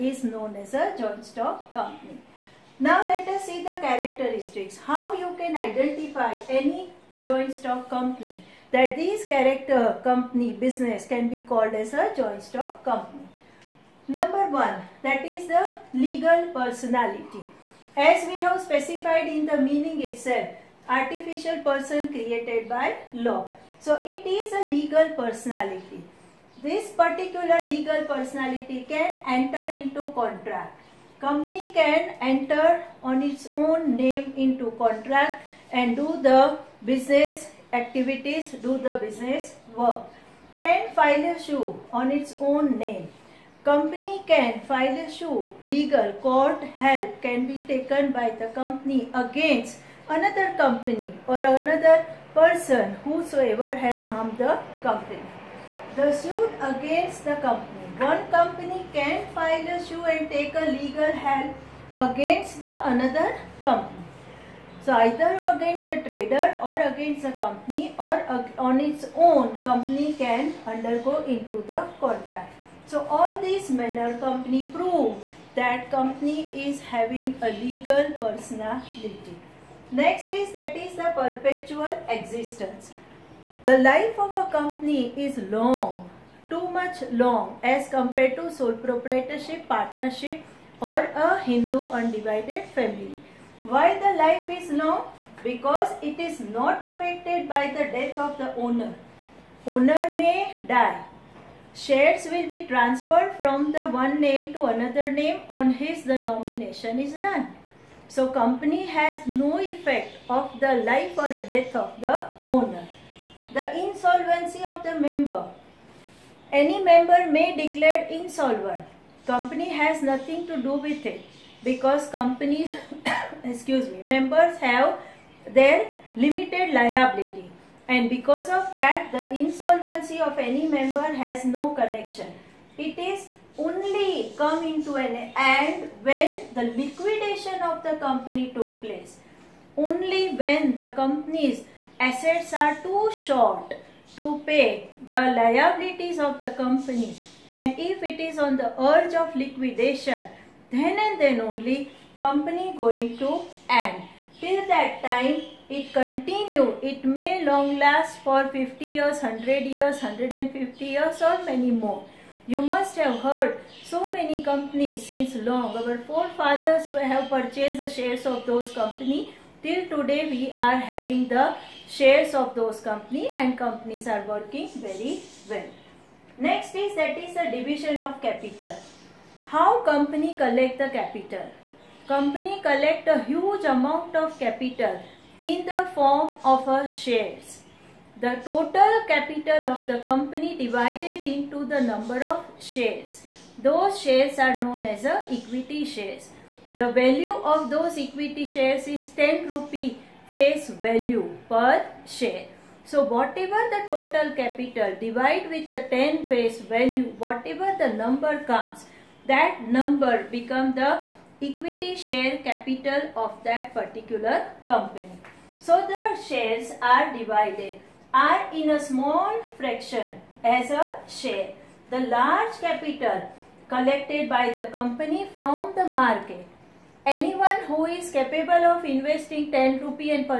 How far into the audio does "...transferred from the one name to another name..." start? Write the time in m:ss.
1:42.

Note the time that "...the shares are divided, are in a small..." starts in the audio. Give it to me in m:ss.
3:35.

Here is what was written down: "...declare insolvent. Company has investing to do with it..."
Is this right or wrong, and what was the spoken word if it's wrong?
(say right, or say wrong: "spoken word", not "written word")
wrong: "nothing", not "investing".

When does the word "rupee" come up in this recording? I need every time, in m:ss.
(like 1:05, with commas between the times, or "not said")
3:19, 3:49.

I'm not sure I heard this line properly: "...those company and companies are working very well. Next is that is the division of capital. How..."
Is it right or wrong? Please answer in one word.
right.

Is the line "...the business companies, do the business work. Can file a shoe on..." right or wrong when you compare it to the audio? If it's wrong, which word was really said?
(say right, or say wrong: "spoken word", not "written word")
wrong: "activities", not "companies".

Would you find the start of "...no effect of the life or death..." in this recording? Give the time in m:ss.
1:49.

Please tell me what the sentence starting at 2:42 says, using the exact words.
You must have heard so many companies since long.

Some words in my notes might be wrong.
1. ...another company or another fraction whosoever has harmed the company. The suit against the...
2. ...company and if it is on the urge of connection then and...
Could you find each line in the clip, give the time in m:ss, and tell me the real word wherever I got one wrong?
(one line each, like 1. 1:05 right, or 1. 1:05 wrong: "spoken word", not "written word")
1. 0:50 wrong: "person", not "fraction"
2. 2:26 wrong: "liquidation", not "connection".